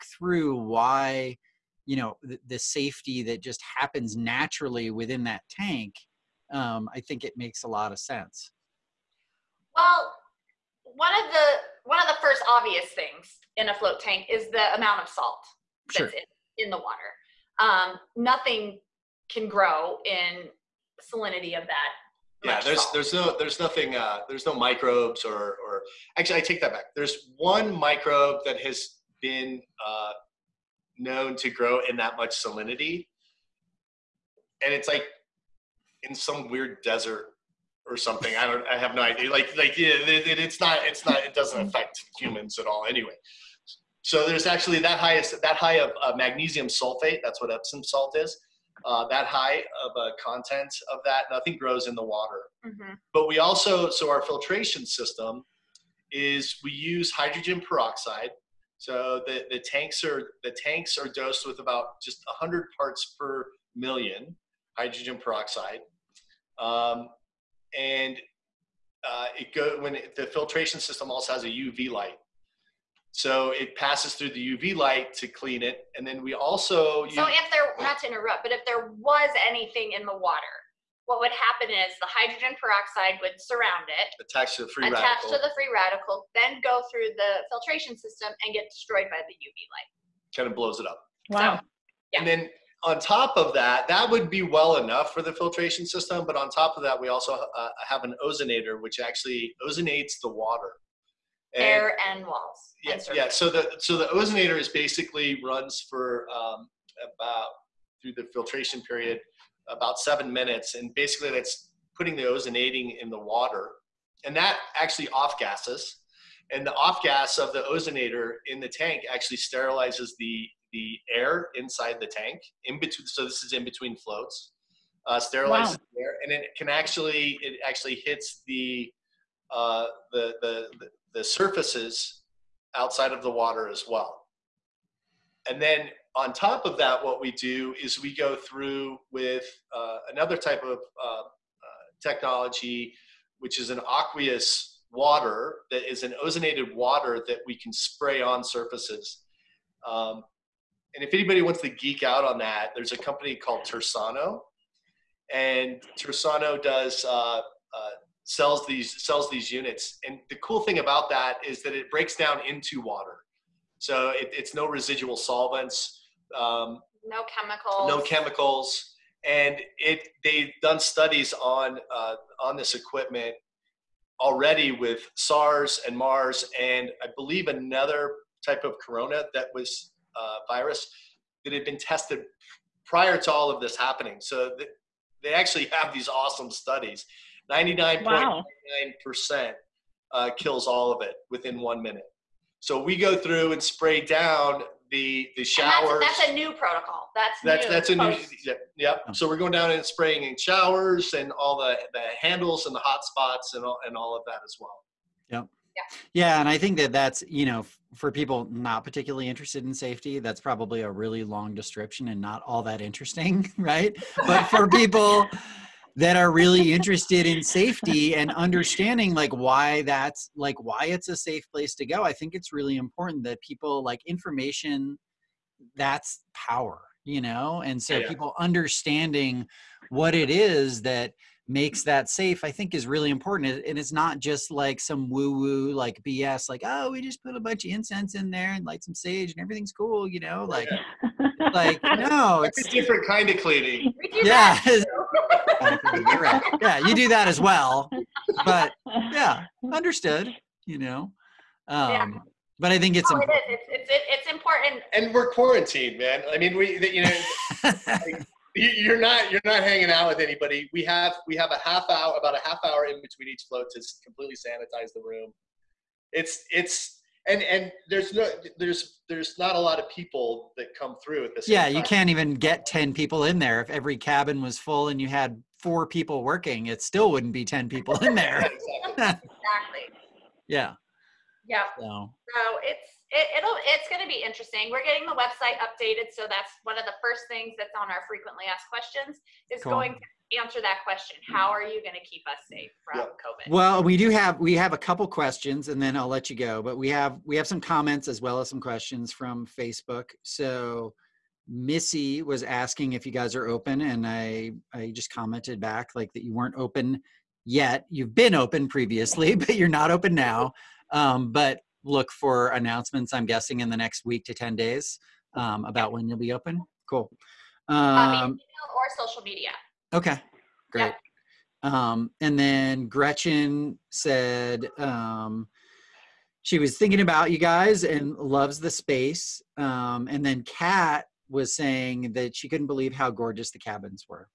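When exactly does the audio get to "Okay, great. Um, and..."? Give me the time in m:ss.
5:19.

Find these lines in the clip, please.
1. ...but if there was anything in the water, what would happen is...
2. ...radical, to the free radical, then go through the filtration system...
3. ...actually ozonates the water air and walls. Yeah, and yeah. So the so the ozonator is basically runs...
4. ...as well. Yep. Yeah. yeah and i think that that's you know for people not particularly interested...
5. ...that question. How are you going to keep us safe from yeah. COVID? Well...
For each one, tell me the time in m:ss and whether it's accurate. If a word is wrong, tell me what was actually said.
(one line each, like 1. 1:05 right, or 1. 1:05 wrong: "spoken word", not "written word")
1. 1:18 right
2. 1:25 right
3. 1:38 right
4. 3:24 right
5. 4:50 right.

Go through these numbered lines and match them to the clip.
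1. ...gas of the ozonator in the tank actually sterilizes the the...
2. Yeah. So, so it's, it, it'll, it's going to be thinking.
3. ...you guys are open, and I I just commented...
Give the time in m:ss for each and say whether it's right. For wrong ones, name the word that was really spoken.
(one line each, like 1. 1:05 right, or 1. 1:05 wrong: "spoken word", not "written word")
1. 1:57 right
2. 4:41 wrong: "interesting", not "thinking"
3. 5:03 right.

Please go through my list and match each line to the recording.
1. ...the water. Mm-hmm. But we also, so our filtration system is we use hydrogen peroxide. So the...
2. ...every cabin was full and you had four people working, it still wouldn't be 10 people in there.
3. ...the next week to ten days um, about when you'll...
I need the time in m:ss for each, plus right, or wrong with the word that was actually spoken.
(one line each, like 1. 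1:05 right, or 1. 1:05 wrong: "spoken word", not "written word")
1. 0:51 right
2. 4:33 right
3. 5:13 right.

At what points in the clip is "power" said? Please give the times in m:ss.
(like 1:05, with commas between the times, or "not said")
3:46.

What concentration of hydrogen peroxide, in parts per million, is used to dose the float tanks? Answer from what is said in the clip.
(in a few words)
100.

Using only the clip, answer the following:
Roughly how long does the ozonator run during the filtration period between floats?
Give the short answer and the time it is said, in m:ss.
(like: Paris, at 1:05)
7 minutes, at 1:49.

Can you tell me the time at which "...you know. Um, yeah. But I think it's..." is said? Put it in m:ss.
4:10.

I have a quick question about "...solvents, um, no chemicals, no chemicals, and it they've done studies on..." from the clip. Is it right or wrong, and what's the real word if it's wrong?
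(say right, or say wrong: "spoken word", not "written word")
right.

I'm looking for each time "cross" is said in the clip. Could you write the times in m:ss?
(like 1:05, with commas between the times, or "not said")
not said.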